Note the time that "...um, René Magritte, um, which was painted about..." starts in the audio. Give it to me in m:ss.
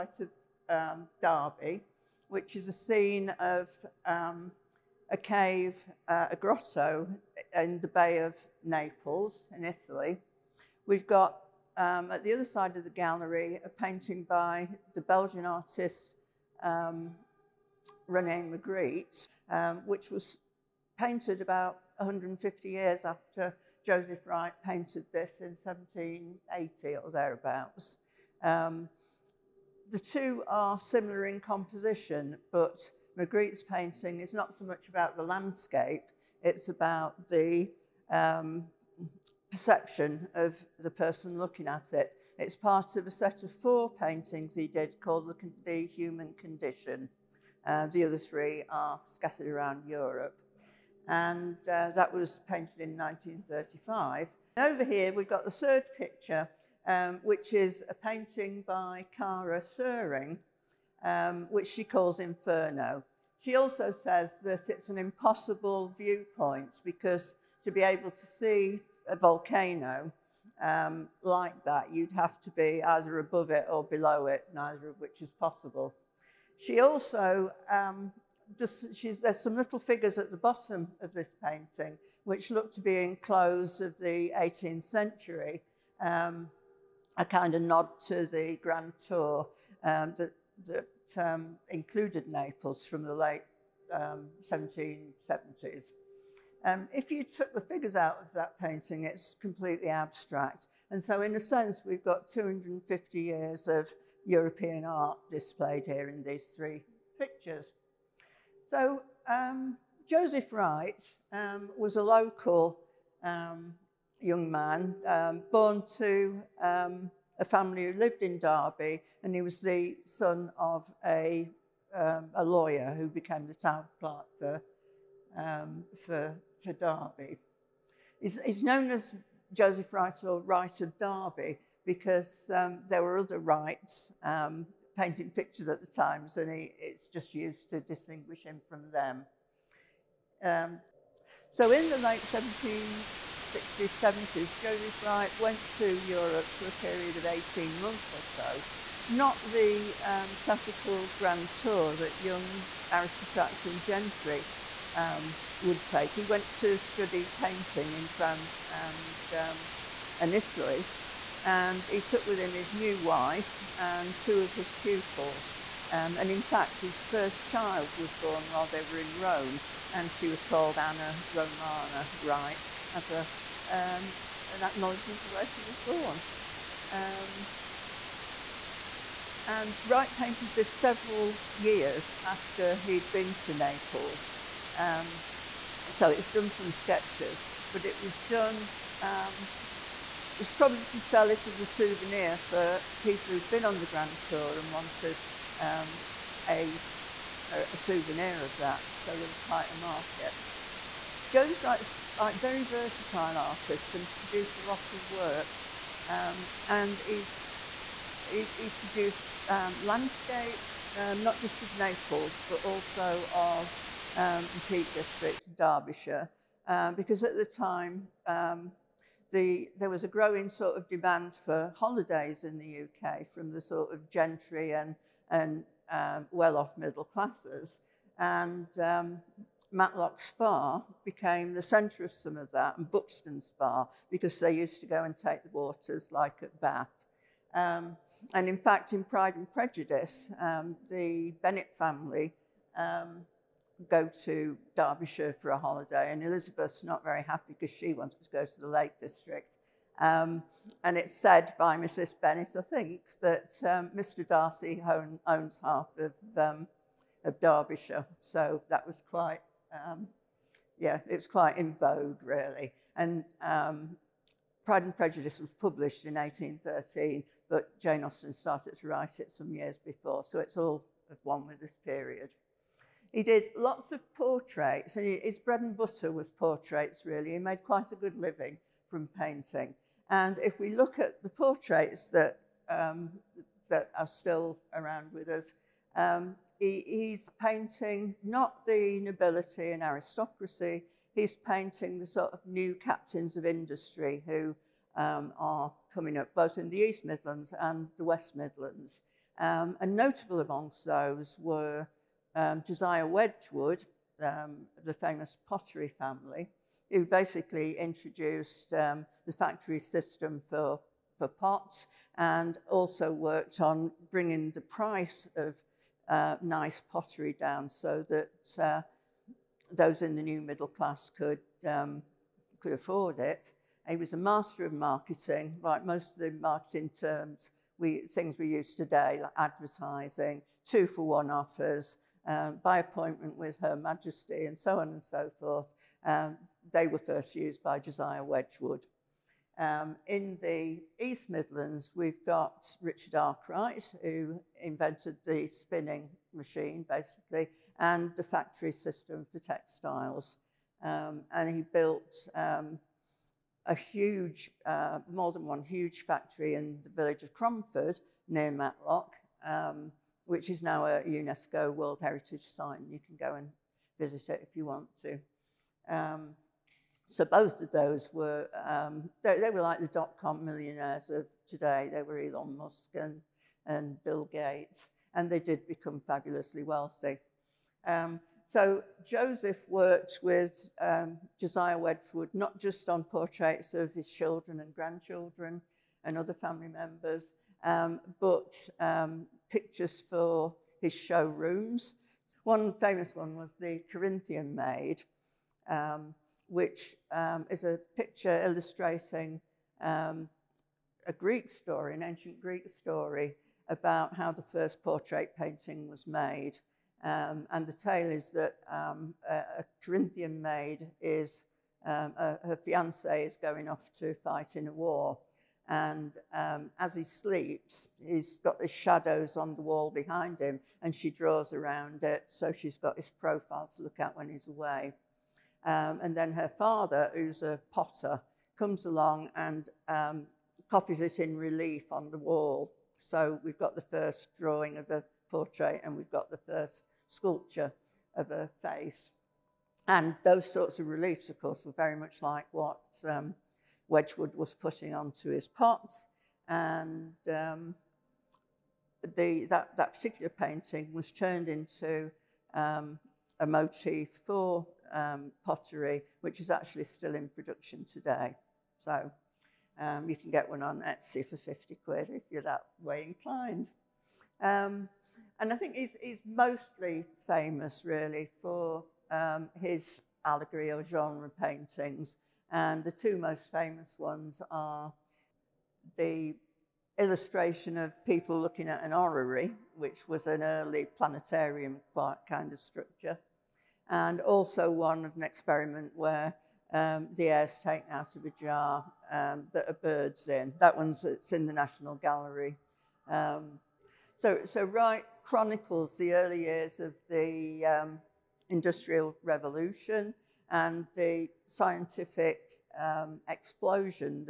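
0:16.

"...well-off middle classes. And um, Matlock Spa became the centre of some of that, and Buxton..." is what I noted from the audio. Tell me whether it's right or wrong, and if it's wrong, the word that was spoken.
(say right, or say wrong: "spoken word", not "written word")
right.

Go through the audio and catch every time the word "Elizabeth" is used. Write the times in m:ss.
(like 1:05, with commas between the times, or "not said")
4:06.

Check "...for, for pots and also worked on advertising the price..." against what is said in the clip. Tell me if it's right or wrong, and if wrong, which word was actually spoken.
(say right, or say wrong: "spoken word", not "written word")
wrong: "bringing", not "advertising".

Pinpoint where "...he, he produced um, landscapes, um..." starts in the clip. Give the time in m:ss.
3:28.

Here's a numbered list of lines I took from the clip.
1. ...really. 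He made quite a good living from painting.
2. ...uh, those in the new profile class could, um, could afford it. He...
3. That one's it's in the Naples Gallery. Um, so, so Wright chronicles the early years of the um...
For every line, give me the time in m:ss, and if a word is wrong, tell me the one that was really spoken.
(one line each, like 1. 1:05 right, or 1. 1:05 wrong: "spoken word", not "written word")
1. 4:37 right
2. 5:18 wrong: "middle", not "profile"
3. 8:10 wrong: "National", not "Naples".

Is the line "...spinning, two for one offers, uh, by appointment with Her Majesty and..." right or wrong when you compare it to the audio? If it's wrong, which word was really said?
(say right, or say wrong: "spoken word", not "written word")
wrong: "advertising", not "spinning".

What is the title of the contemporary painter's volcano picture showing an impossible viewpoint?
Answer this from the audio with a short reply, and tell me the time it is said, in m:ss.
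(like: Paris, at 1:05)
Inferno, at 1:02.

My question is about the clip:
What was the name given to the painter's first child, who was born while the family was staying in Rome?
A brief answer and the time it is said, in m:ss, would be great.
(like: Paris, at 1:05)
Anna Romana Wright, at 2:50.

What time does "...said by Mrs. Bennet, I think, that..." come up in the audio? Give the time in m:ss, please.
4:11.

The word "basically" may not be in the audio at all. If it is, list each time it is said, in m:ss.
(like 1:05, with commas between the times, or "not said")
5:07, 5:46.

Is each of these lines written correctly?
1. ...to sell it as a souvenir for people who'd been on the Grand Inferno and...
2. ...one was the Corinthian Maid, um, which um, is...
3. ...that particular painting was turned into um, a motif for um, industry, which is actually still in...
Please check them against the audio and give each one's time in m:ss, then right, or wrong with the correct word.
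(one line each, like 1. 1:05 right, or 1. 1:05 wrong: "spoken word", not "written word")
1. 3:10 wrong: "Tour", not "Inferno"
2. 6:33 right
3. 7:29 wrong: "pottery", not "industry".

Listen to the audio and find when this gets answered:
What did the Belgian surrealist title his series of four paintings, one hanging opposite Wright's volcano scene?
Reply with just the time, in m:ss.
0:45.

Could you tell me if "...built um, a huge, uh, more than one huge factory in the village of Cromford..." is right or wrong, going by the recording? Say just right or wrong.
right.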